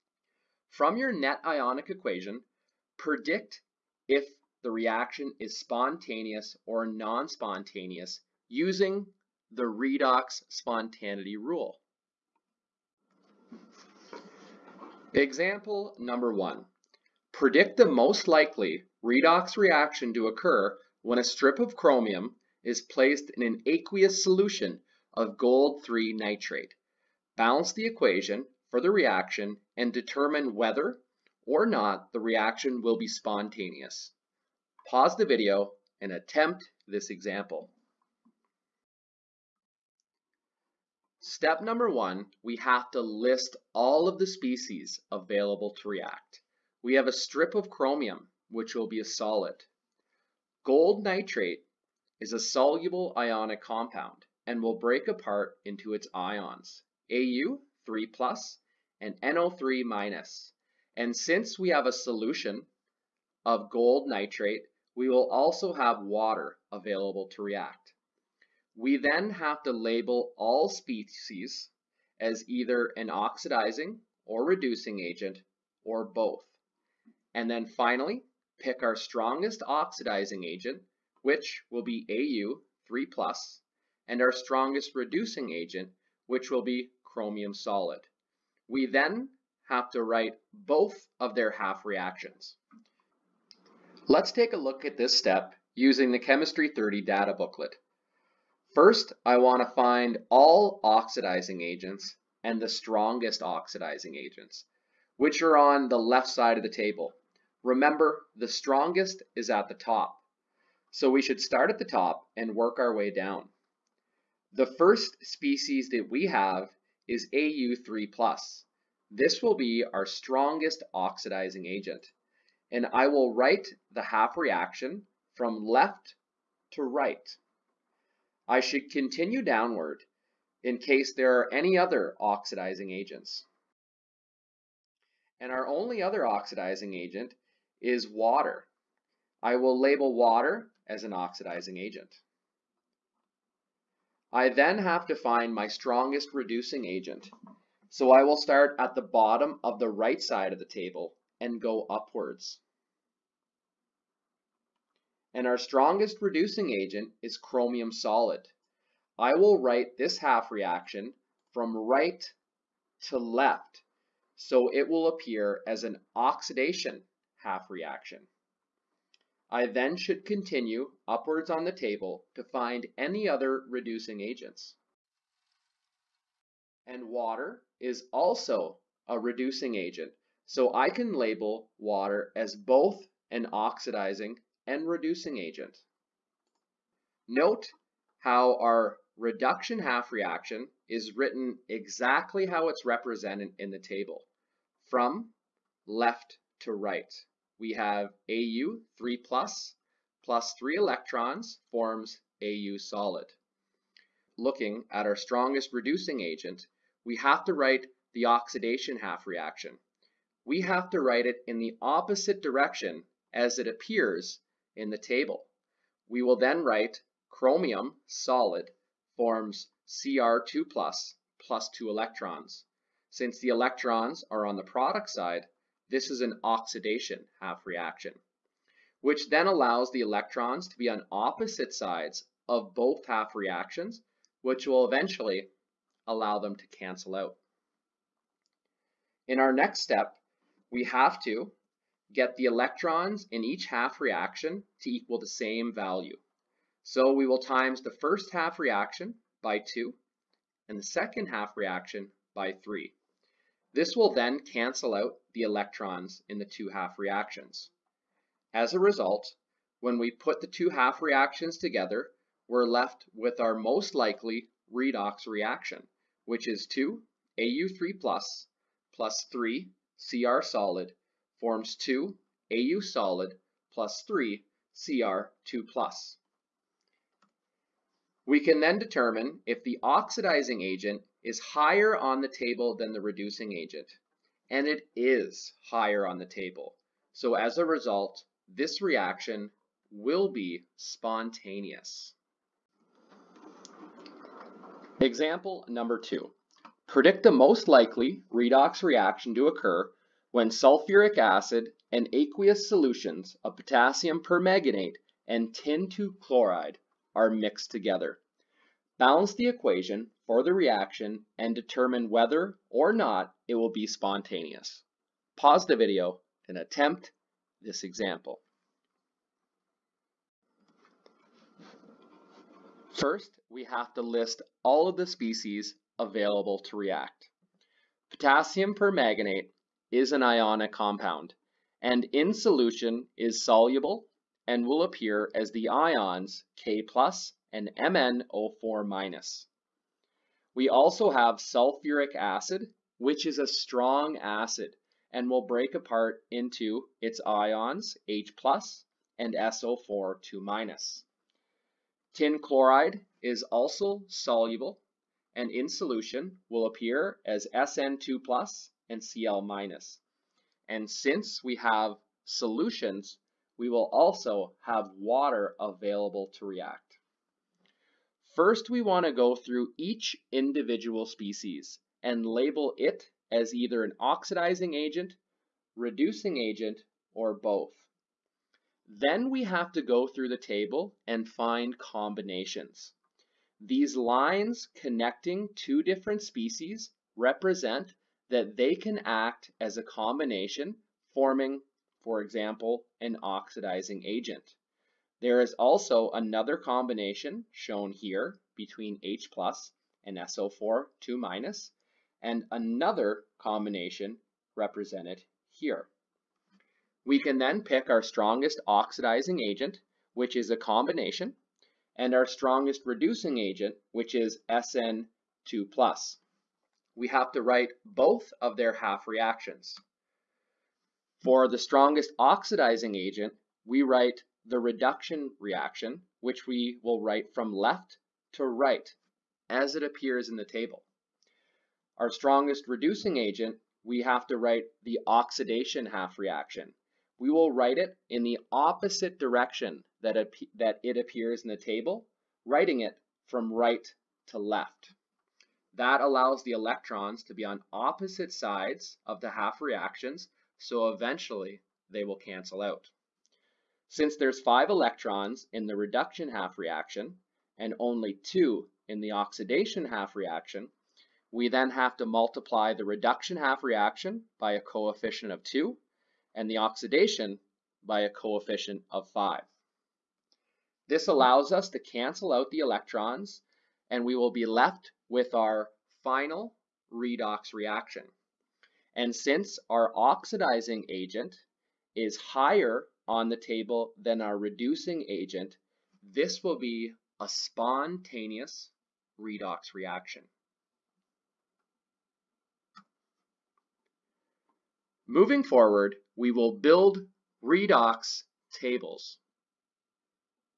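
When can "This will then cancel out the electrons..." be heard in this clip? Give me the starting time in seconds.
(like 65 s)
253 s.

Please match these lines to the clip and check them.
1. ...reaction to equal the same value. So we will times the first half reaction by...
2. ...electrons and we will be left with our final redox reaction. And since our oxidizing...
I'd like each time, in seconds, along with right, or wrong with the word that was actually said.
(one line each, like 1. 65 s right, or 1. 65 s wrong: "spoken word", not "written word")
1. 243 s right
2. 472 s right.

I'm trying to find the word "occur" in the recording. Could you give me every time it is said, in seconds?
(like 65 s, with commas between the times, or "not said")
20 s, 299 s.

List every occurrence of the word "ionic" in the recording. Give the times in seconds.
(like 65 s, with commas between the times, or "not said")
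1 s, 53 s, 330 s.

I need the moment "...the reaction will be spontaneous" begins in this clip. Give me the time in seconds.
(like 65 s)
32 s.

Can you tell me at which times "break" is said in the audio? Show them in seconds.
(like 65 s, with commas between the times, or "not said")
54 s, 345 s.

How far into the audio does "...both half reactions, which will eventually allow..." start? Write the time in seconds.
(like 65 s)
232 s.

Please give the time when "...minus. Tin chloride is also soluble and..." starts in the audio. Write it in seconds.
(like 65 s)
350 s.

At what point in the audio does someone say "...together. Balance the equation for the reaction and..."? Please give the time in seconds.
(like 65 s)
307 s.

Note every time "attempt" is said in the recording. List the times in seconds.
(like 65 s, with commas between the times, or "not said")
36 s, 316 s.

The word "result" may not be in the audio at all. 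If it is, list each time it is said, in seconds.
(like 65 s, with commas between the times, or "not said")
258 s, 287 s.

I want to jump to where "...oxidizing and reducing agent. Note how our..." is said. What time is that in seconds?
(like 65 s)
183 s.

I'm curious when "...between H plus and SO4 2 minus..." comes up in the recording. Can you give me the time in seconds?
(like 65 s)
398 s.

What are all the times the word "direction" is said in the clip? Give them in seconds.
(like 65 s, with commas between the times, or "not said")
212 s, 439 s.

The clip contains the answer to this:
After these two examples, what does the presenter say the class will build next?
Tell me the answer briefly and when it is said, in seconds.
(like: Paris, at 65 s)
Redox tables, at 497 s.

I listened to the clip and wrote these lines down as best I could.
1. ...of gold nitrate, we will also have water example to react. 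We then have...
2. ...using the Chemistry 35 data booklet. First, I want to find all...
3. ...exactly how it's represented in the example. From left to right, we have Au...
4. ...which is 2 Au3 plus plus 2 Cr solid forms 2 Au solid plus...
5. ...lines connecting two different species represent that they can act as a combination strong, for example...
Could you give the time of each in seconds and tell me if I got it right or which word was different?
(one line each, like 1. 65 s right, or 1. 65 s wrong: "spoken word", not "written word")
1. 63 s wrong: "available", not "example"
2. 95 s wrong: "30", not "35"
3. 191 s wrong: "table", not "example"
4. 266 s wrong: "3", not "2"
5. 383 s wrong: "forming", not "strong".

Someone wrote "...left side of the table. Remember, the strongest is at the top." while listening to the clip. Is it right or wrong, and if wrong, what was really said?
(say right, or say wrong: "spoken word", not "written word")
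right.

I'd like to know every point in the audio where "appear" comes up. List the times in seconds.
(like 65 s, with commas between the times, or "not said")
165 s, 213 s, 334 s, 356 s, 429 s, 440 s.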